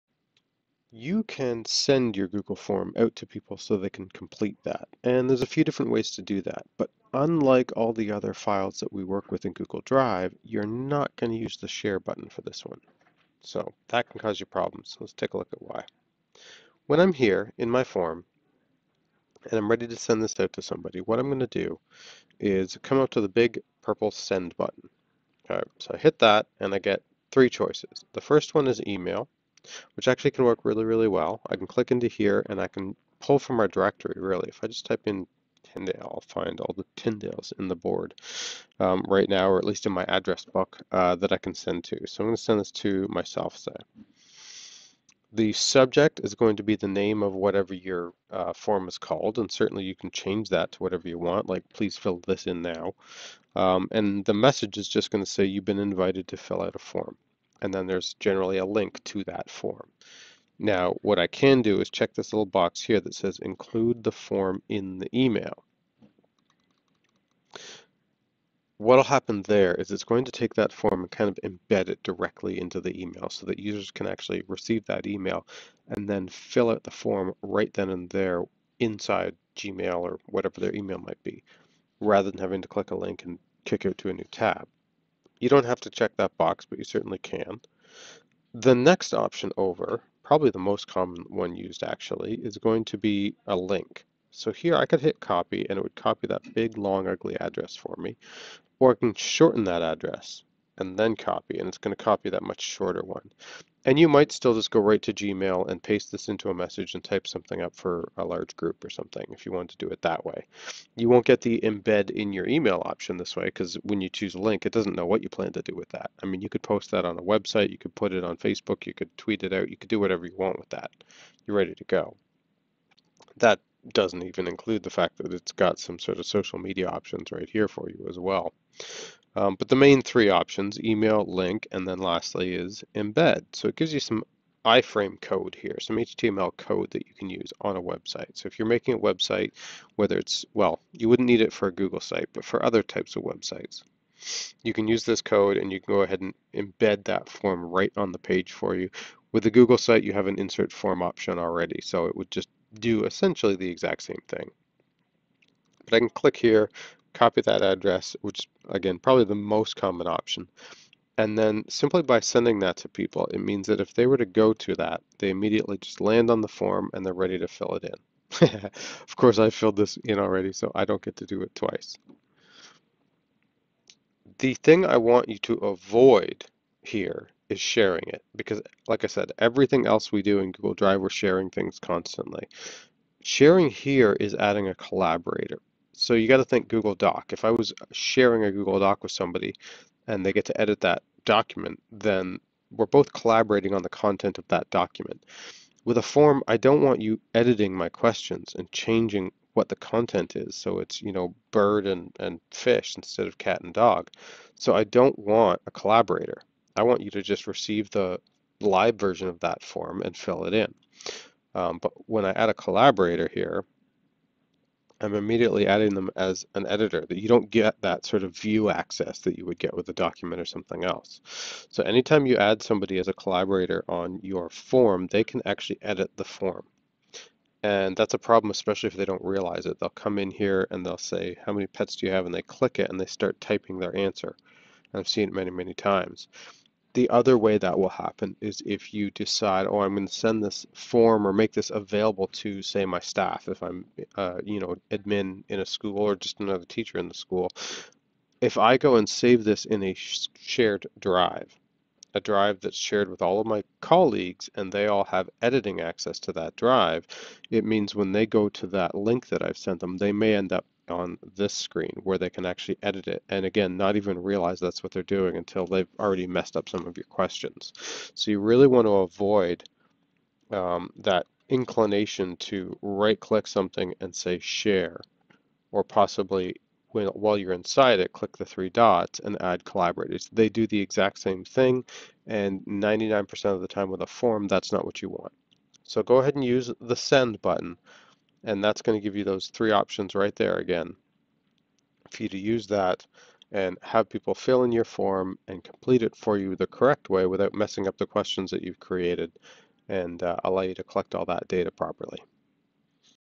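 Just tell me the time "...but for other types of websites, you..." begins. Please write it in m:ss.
2:22.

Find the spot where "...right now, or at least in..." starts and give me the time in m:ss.
0:39.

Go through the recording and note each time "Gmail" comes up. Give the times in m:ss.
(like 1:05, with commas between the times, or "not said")
1:19, 1:45.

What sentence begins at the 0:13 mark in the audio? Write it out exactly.
So that can cause you problems.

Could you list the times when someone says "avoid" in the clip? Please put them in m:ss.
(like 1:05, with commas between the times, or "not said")
2:55, 4:28.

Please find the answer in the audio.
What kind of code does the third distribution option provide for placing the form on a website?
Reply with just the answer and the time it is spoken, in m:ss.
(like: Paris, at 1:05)
iframe code, at 2:14.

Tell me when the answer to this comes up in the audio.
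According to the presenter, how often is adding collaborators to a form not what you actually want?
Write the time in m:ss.
4:42.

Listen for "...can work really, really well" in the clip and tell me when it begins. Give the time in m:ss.
0:30.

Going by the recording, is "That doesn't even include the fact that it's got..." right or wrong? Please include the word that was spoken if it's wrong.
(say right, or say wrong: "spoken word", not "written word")
right.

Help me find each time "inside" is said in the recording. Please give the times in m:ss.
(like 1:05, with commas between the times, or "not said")
1:18, 4:37.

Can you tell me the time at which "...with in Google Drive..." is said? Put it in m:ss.
0:09.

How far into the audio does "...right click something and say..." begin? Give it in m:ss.
4:32.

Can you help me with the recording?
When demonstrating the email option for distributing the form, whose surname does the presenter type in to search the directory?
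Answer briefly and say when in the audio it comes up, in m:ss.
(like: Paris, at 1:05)
Tyndale, at 0:35.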